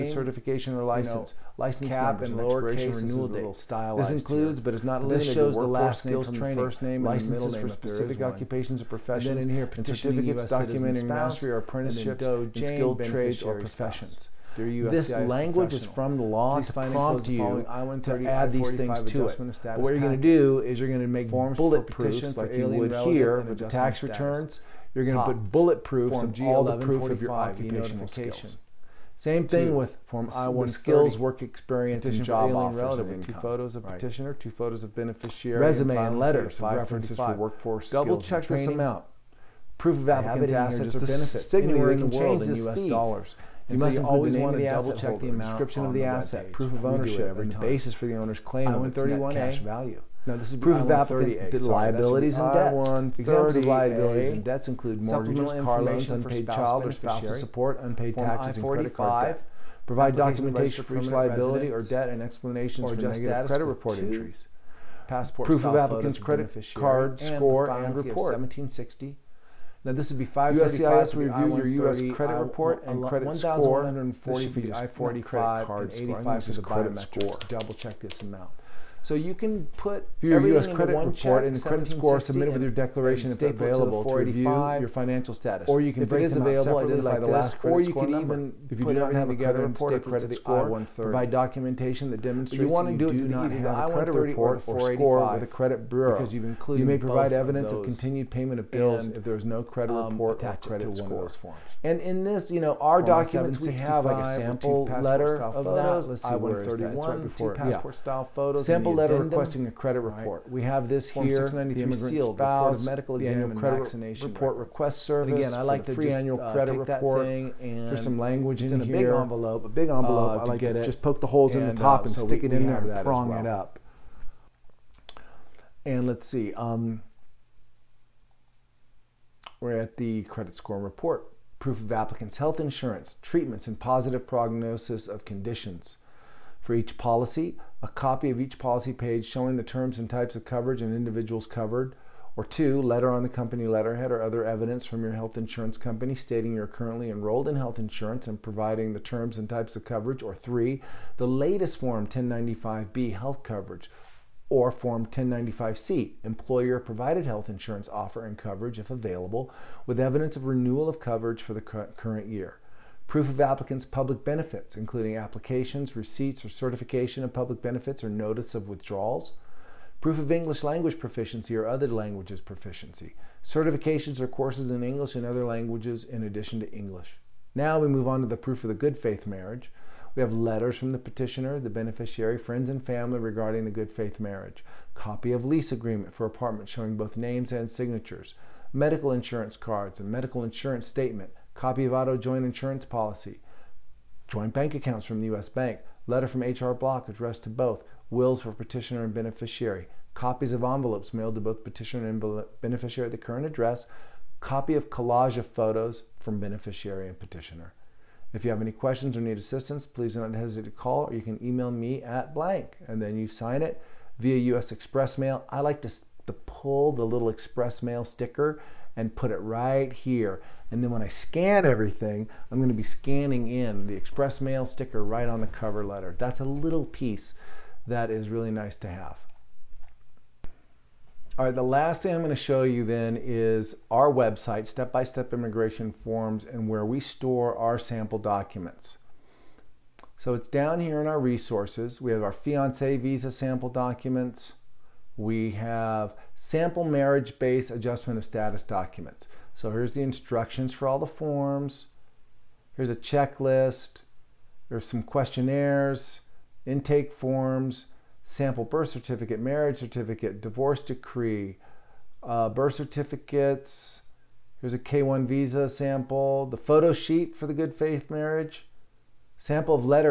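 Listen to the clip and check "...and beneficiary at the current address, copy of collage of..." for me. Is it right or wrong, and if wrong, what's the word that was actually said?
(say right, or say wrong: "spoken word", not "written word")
right.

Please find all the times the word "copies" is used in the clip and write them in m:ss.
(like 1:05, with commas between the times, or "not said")
3:20.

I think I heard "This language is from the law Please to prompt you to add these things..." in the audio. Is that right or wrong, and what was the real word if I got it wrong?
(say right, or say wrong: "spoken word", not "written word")
right.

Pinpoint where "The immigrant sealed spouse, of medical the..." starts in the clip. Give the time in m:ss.
1:51.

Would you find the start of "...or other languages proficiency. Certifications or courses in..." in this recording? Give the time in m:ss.
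2:51.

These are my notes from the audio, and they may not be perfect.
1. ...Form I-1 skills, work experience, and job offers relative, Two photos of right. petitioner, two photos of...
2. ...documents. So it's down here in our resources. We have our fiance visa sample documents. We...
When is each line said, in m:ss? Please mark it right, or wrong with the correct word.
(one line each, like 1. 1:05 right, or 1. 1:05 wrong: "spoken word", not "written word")
1. 0:30 right
2. 3:58 right.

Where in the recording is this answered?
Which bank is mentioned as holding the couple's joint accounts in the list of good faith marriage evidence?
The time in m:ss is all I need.
3:15.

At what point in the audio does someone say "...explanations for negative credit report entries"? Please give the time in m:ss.
1:02.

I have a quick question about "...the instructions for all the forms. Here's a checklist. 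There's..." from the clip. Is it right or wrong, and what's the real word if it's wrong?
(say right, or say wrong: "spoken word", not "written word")
right.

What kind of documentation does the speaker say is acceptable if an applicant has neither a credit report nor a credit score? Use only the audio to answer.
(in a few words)
Continued payment of bills.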